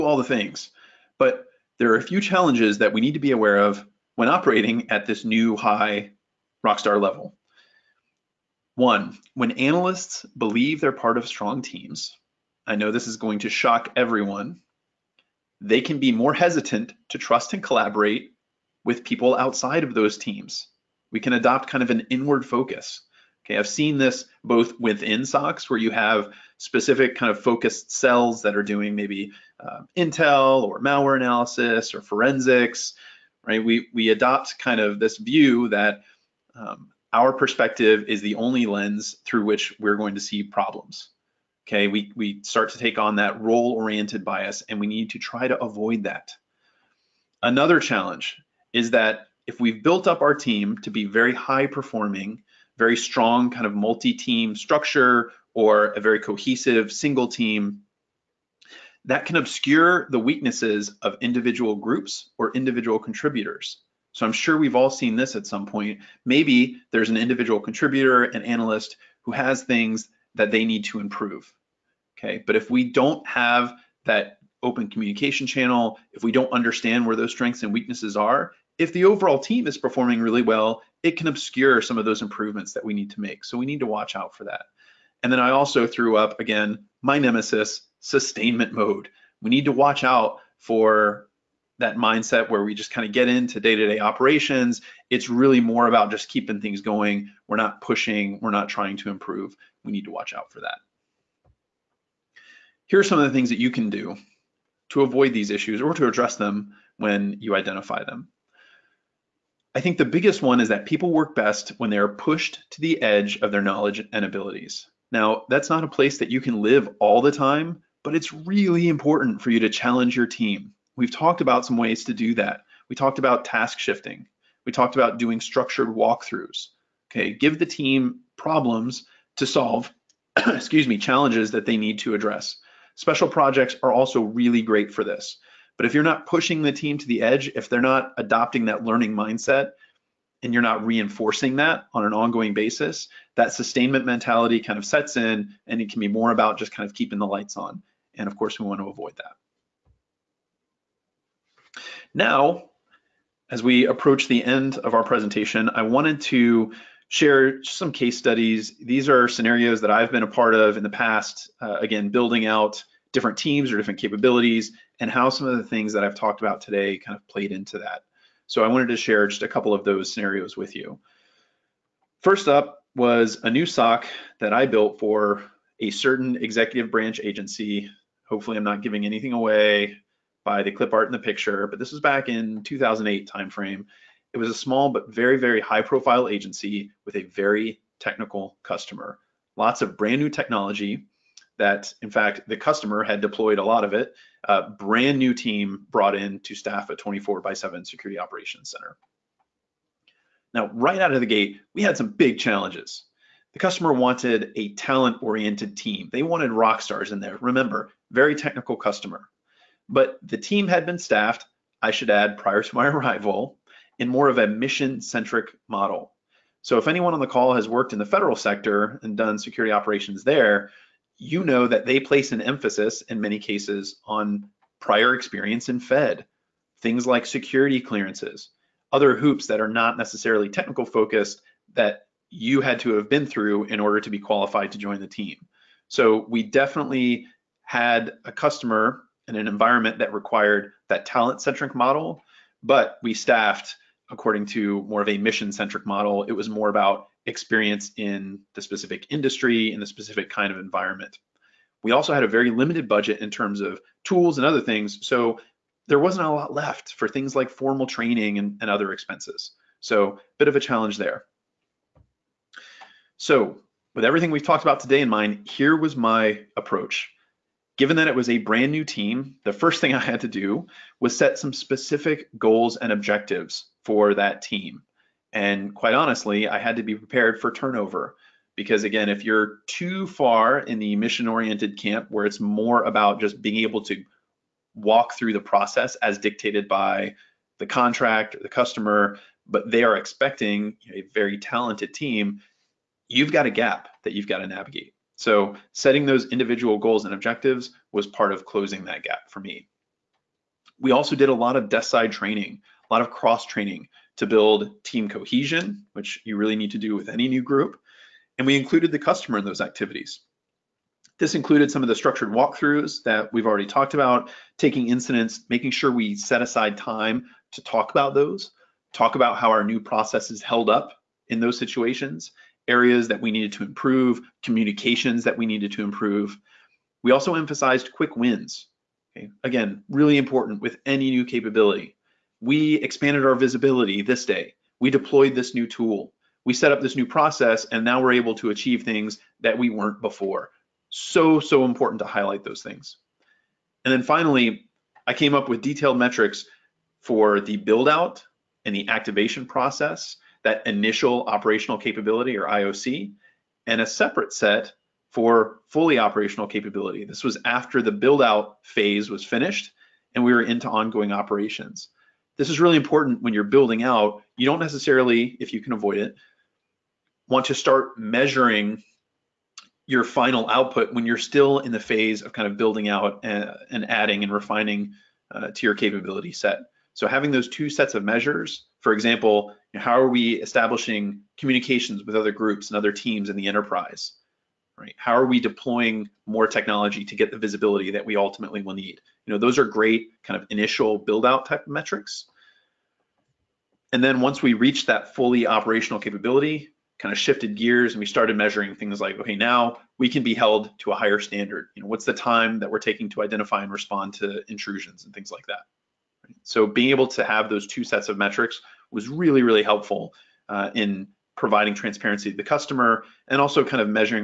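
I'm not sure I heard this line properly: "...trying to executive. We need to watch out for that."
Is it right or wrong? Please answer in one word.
wrong.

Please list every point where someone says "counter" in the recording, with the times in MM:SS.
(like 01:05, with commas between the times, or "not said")
not said.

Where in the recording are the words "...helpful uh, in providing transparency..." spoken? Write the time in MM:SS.
06:49.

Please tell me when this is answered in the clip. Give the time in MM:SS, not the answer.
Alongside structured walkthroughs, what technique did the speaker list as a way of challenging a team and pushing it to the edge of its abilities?
02:03.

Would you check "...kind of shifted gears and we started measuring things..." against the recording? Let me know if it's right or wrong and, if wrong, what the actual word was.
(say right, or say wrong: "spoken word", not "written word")
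right.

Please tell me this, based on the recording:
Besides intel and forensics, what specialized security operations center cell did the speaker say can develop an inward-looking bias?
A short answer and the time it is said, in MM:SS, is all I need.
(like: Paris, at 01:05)
malware analysis, at 00:30.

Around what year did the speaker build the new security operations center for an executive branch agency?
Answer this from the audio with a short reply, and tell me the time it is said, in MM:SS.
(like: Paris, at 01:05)
2008, at 03:02.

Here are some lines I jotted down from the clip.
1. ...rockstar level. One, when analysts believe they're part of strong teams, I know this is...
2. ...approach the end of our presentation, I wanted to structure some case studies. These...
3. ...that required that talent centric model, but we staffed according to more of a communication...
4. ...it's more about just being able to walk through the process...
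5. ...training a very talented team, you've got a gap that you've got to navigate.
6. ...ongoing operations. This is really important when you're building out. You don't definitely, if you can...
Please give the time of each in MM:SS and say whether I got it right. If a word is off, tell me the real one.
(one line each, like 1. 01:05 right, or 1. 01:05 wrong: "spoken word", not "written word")
1. 00:06 right
2. 02:33 wrong: "share", not "structure"
3. 03:59 wrong: "mission", not "communication"
4. 04:42 right
5. 04:49 wrong: "expecting", not "training"
6. 06:00 wrong: "necessarily", not "definitely".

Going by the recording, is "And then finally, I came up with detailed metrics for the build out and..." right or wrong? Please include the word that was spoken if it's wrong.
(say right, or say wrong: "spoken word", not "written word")
right.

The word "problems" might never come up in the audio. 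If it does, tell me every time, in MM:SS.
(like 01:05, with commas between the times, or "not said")
00:40, 02:08.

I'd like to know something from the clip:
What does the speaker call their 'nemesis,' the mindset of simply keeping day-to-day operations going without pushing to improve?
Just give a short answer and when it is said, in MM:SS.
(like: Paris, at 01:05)
sustainment mode, at 01:27.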